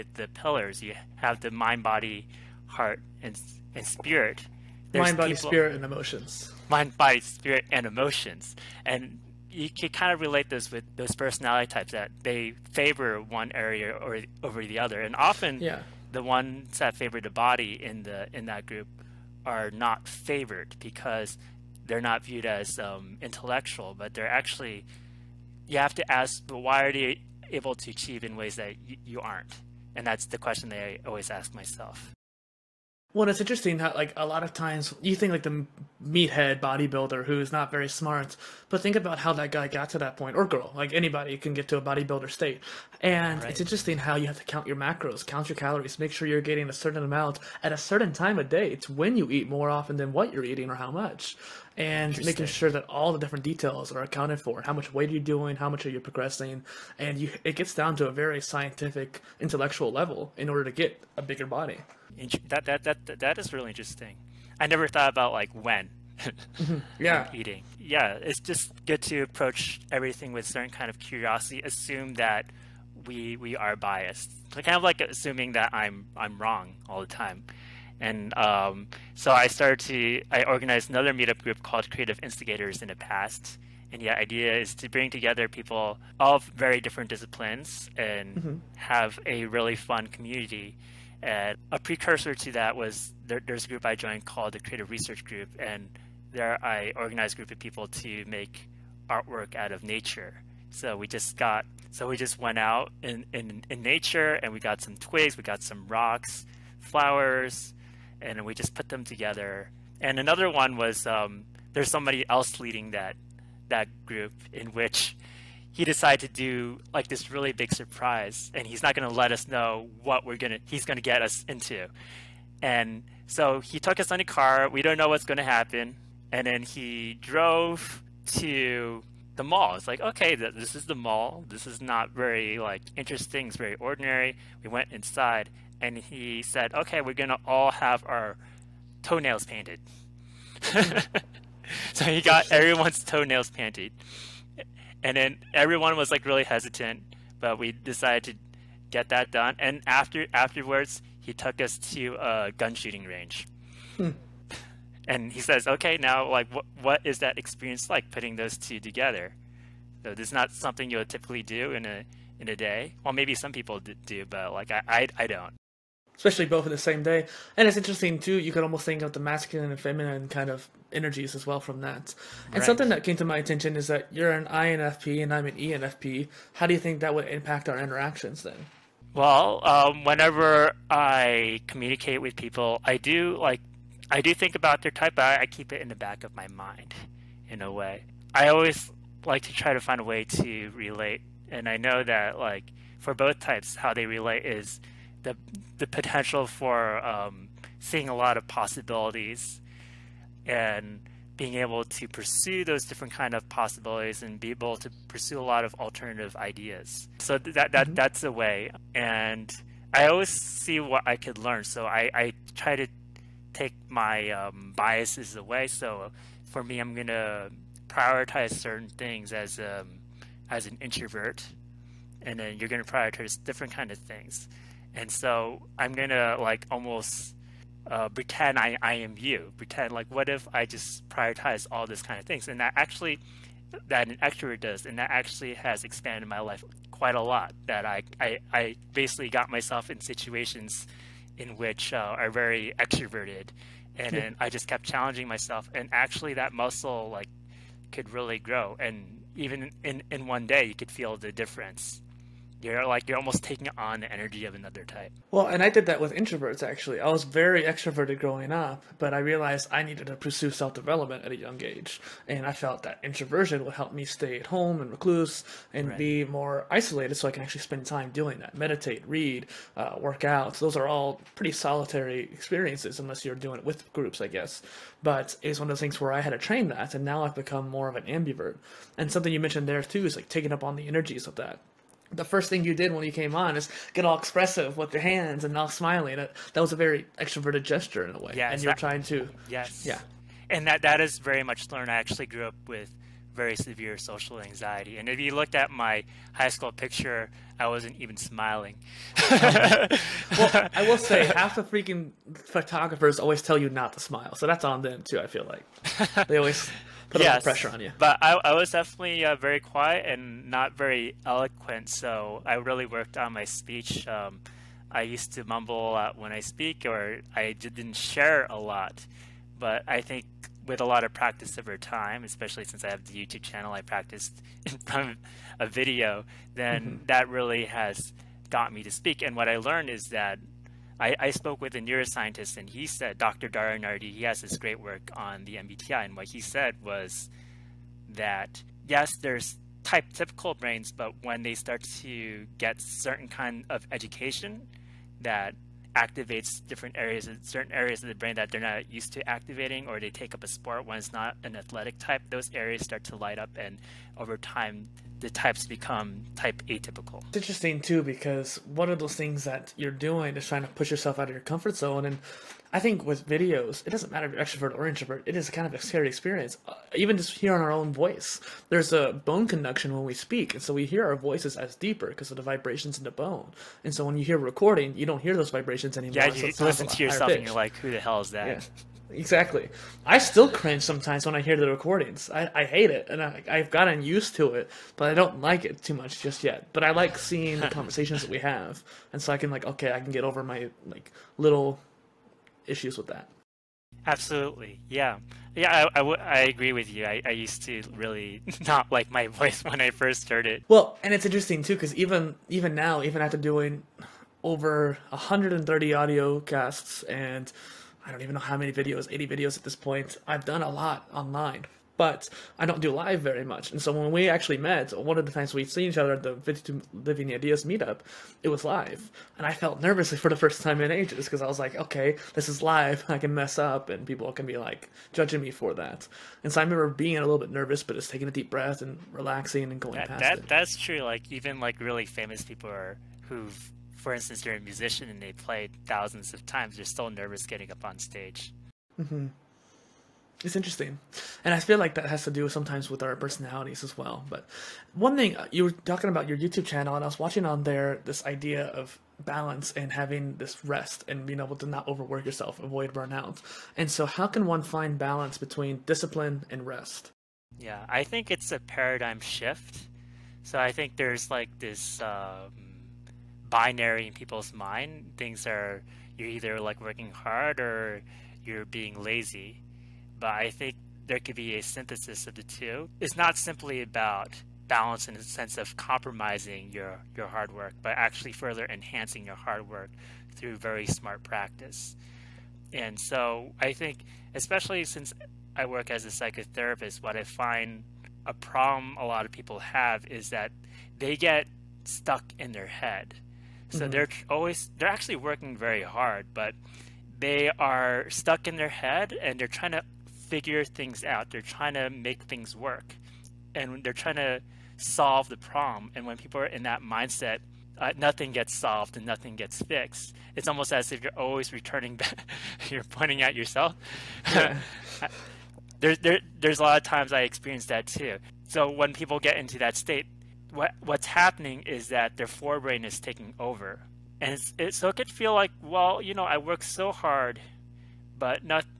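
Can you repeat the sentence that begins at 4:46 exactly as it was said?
That, that was a very extroverted gesture in a way.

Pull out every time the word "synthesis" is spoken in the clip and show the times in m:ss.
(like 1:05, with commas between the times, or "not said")
7:51.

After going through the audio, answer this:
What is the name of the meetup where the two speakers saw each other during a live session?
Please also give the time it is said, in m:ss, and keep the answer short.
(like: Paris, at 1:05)
52 Living Ideas, at 6:56.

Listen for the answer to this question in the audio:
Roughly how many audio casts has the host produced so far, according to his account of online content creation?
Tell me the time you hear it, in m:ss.
6:45.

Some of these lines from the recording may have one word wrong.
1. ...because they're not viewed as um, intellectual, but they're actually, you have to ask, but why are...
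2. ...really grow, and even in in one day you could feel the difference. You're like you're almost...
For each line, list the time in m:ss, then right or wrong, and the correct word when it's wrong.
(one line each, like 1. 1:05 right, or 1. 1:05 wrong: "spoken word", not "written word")
1. 0:20 right
2. 4:08 right.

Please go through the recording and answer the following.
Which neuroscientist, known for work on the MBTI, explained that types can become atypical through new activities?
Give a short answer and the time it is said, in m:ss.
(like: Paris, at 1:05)
Dr. Dario, at 5:33.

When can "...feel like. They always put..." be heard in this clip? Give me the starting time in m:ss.
5:05.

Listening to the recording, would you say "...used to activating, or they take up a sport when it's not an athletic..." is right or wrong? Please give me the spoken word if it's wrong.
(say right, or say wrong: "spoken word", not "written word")
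right.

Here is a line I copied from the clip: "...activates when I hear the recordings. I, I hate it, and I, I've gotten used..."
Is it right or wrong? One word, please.
wrong.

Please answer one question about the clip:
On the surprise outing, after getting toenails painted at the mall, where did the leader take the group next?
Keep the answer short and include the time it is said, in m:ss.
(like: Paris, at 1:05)
A gun shooting range, at 2:32.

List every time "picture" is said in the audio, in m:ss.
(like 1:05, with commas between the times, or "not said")
4:56.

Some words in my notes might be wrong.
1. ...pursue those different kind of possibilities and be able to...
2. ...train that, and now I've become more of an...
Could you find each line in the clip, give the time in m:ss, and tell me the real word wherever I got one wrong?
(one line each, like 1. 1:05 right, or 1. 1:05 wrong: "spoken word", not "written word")
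1. 3:22 right
2. 4:36 right.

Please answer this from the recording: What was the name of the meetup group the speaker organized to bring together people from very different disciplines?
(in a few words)
Creative Instigators.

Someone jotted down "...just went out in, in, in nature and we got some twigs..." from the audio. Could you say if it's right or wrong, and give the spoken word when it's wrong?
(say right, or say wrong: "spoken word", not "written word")
right.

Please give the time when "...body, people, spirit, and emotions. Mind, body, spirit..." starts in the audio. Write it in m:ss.
0:05.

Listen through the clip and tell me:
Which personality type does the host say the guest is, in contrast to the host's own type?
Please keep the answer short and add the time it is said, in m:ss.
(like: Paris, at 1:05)
INFP, at 2:54.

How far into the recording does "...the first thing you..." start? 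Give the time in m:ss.
4:42.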